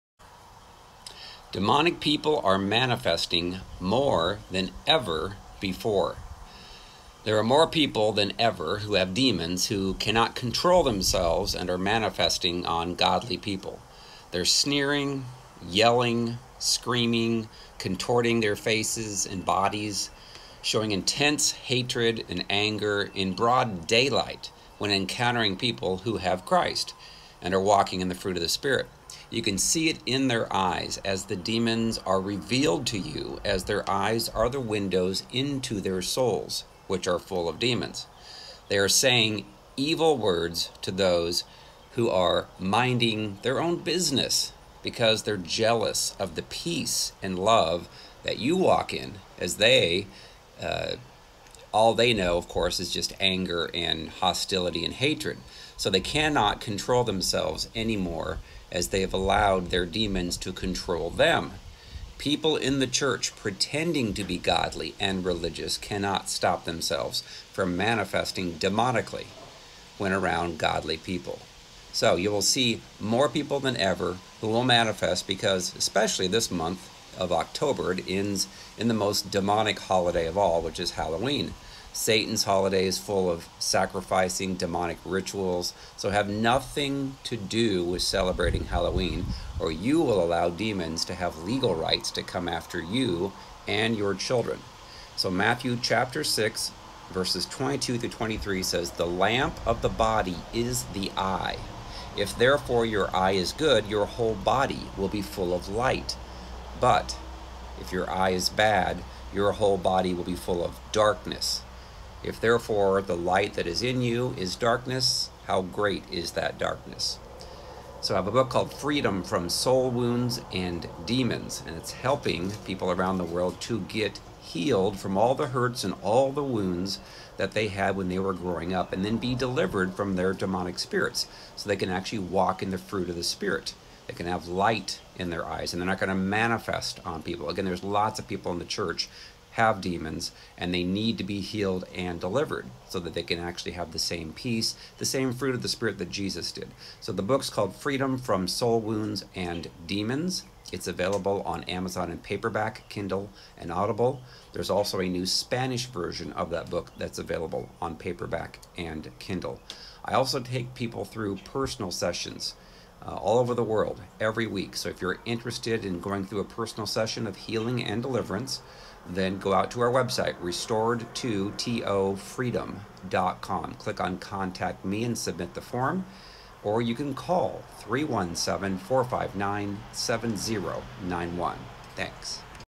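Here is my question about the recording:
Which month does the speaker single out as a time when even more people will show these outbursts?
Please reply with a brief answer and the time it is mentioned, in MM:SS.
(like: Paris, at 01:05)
October, at 01:17.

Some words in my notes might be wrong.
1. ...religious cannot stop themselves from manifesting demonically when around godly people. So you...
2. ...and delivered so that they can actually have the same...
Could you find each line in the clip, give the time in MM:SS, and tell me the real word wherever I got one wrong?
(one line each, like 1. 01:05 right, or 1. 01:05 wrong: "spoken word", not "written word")
1. 01:05 right
2. 02:21 right.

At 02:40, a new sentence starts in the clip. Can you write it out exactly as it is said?
I also take people through personal sessions uh, all over the world every week.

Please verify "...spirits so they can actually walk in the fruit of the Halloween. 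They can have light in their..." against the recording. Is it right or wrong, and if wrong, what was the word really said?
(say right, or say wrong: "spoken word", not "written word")
wrong: "Spirit", not "Halloween".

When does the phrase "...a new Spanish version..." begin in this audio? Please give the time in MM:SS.
02:34.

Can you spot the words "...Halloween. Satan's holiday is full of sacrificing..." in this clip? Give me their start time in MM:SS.
01:20.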